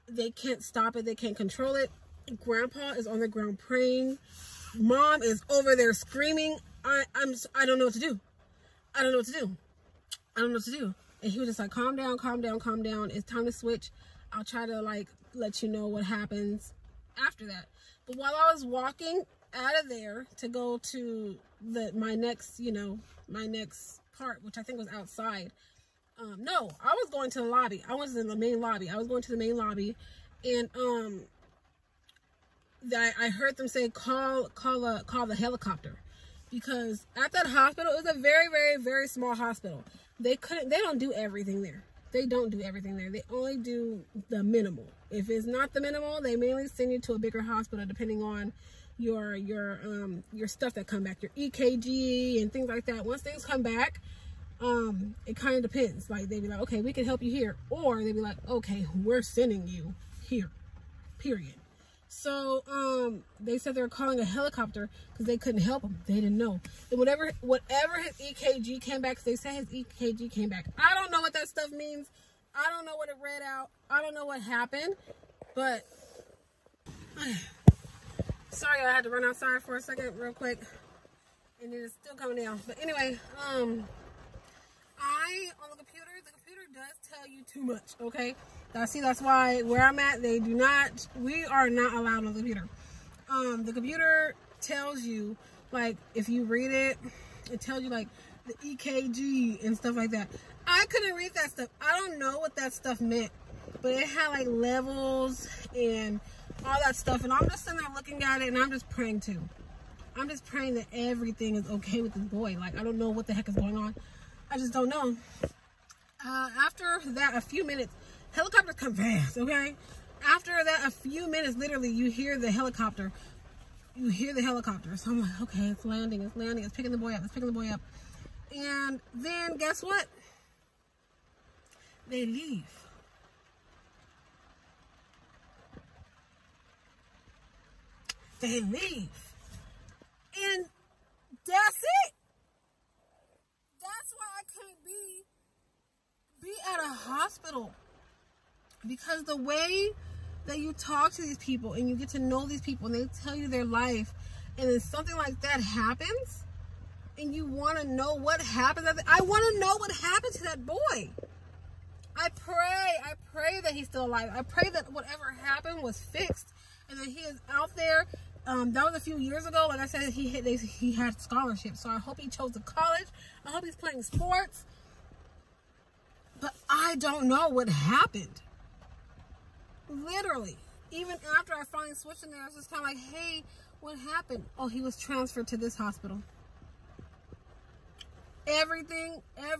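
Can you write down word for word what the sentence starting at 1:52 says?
Like, I don't know what the heck is going on.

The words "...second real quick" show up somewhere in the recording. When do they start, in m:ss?
1:19.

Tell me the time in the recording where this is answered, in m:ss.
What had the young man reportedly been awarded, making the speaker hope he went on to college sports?
2:51.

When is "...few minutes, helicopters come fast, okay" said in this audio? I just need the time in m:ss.
1:57.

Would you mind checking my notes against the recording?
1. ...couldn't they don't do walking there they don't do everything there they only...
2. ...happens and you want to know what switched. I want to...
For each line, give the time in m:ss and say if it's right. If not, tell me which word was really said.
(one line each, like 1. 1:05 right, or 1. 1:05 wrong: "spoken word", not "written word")
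1. 0:40 wrong: "everything", not "walking"
2. 2:35 wrong: "happened", not "switched".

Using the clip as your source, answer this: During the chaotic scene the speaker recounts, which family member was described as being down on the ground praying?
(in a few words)
Grandpa.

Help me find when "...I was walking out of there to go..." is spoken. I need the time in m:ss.
0:18.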